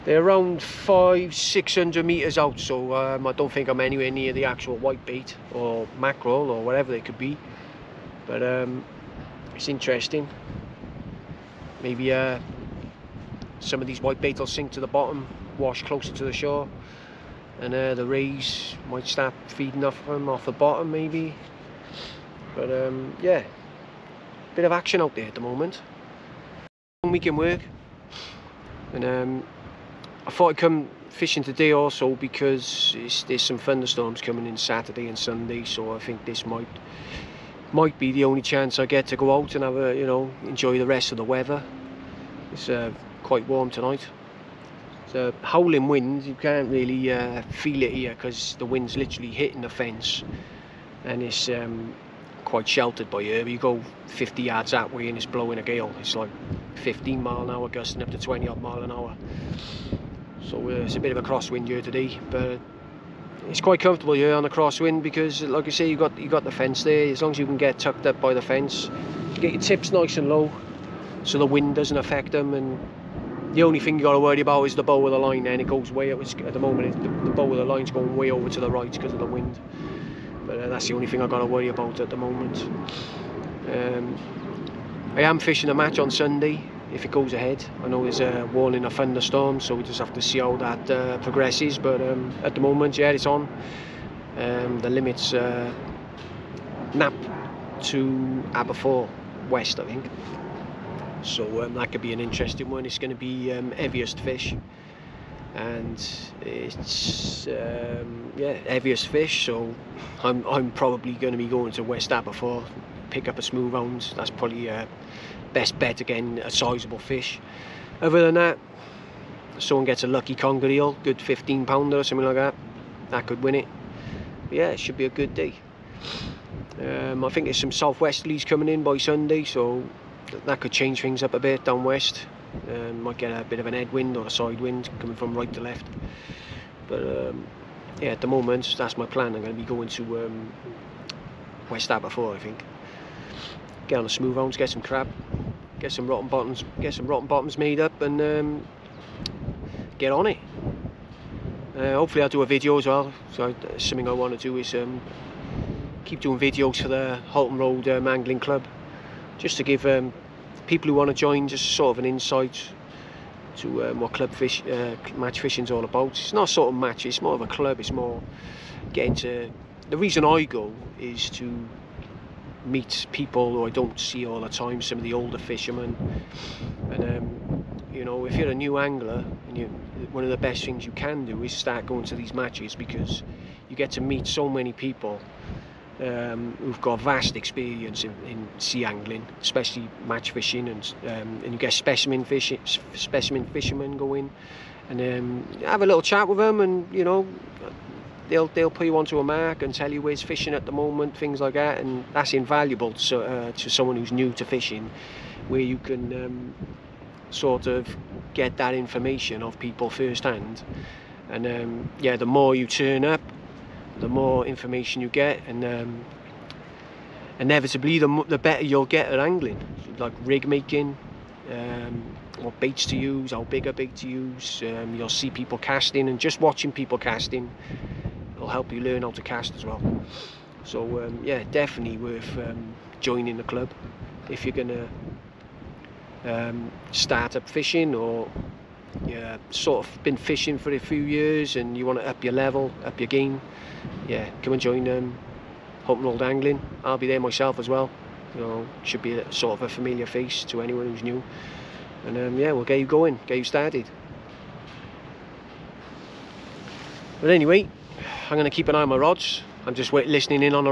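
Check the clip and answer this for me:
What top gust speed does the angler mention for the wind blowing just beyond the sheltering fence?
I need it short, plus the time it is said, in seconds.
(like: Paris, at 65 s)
20 mph, at 58 s.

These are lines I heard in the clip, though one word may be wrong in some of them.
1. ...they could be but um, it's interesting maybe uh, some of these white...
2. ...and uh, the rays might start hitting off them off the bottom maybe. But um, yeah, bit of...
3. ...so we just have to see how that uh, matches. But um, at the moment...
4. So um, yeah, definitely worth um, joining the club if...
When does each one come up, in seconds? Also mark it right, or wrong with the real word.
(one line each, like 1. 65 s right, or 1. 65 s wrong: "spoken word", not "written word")
1. 6 s right
2. 17 s wrong: "feeding", not "hitting"
3. 89 s wrong: "progresses", not "matches"
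4. 230 s right.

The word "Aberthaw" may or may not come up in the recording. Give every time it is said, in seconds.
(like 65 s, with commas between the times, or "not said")
98 s, 112 s, 141 s.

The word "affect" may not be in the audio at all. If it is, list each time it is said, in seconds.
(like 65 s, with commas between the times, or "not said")
71 s.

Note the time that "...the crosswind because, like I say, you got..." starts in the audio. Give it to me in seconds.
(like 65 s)
64 s.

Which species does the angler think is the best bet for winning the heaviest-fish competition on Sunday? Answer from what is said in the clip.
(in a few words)
smooth hound.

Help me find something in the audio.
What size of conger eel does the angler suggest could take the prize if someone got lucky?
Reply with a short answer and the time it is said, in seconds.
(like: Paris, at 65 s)
15 pounds, at 121 s.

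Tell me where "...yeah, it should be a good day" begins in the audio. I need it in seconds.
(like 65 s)
124 s.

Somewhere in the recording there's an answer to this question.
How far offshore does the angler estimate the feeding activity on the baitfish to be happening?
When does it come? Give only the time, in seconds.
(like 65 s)
0 s.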